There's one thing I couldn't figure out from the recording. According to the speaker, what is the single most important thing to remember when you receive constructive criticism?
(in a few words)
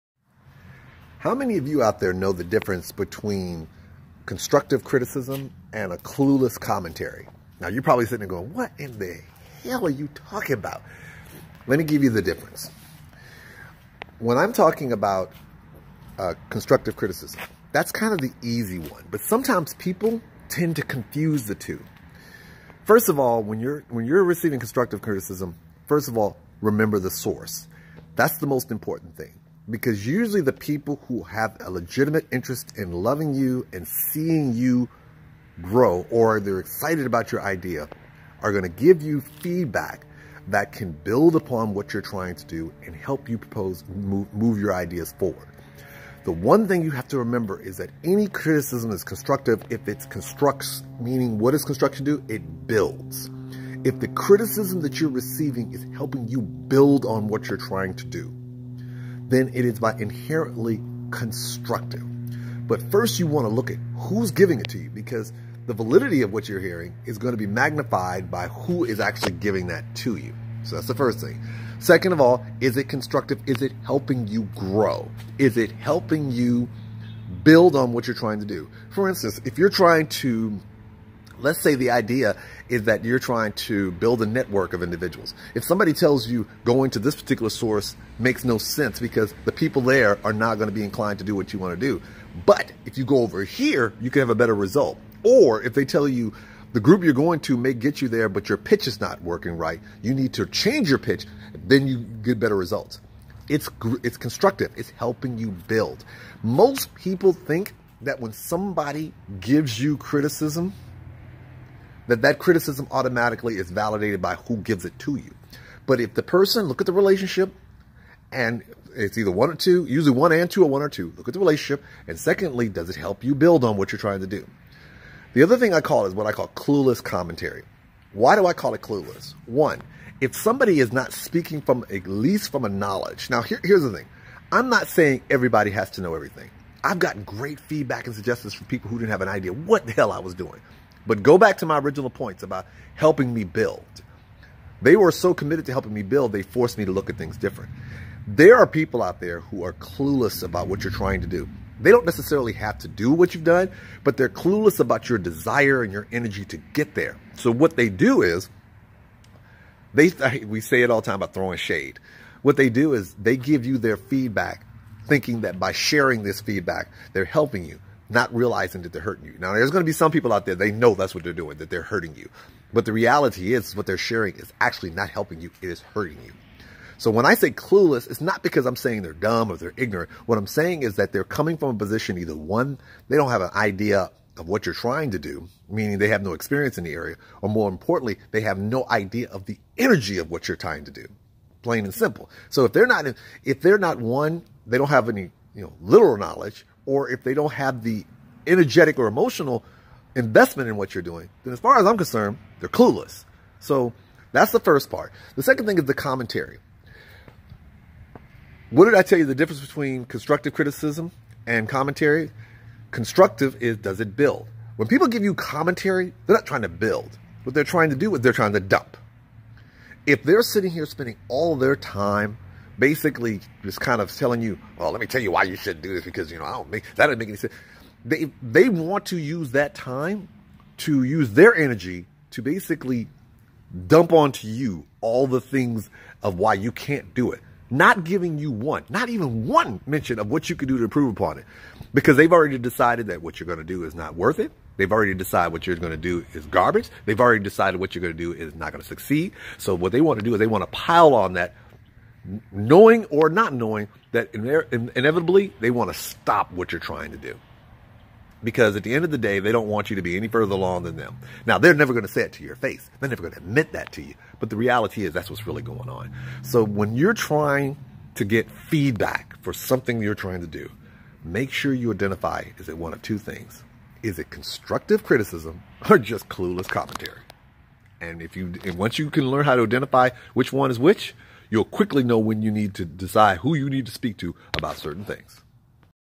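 Remember the source.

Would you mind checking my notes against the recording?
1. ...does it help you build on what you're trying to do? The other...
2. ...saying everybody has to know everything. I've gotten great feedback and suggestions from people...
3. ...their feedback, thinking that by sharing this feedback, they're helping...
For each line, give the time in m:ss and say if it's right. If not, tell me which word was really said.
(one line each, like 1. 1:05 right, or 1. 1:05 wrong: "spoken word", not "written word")
1. 2:02 right
2. 2:14 right
3. 2:43 right.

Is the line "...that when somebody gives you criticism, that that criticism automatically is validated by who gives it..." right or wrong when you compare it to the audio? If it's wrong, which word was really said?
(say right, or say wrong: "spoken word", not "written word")
right.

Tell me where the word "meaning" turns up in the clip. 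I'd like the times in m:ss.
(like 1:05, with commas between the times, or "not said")
0:50, 3:05.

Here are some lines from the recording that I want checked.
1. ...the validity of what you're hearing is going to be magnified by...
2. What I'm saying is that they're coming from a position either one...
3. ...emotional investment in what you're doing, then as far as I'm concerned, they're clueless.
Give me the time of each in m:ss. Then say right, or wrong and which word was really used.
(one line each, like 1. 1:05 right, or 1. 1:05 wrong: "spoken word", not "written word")
1. 1:05 right
2. 3:00 right
3. 3:19 right.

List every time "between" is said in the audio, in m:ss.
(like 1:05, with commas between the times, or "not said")
0:02, 3:29.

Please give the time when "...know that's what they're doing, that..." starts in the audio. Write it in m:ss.
2:50.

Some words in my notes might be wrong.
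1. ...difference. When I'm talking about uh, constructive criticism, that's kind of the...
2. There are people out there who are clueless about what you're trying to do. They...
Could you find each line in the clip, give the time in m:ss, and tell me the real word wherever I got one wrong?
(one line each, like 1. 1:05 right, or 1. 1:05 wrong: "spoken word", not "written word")
1. 0:12 right
2. 2:28 right.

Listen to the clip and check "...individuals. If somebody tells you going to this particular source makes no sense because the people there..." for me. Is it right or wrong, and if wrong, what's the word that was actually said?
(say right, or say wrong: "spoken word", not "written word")
right.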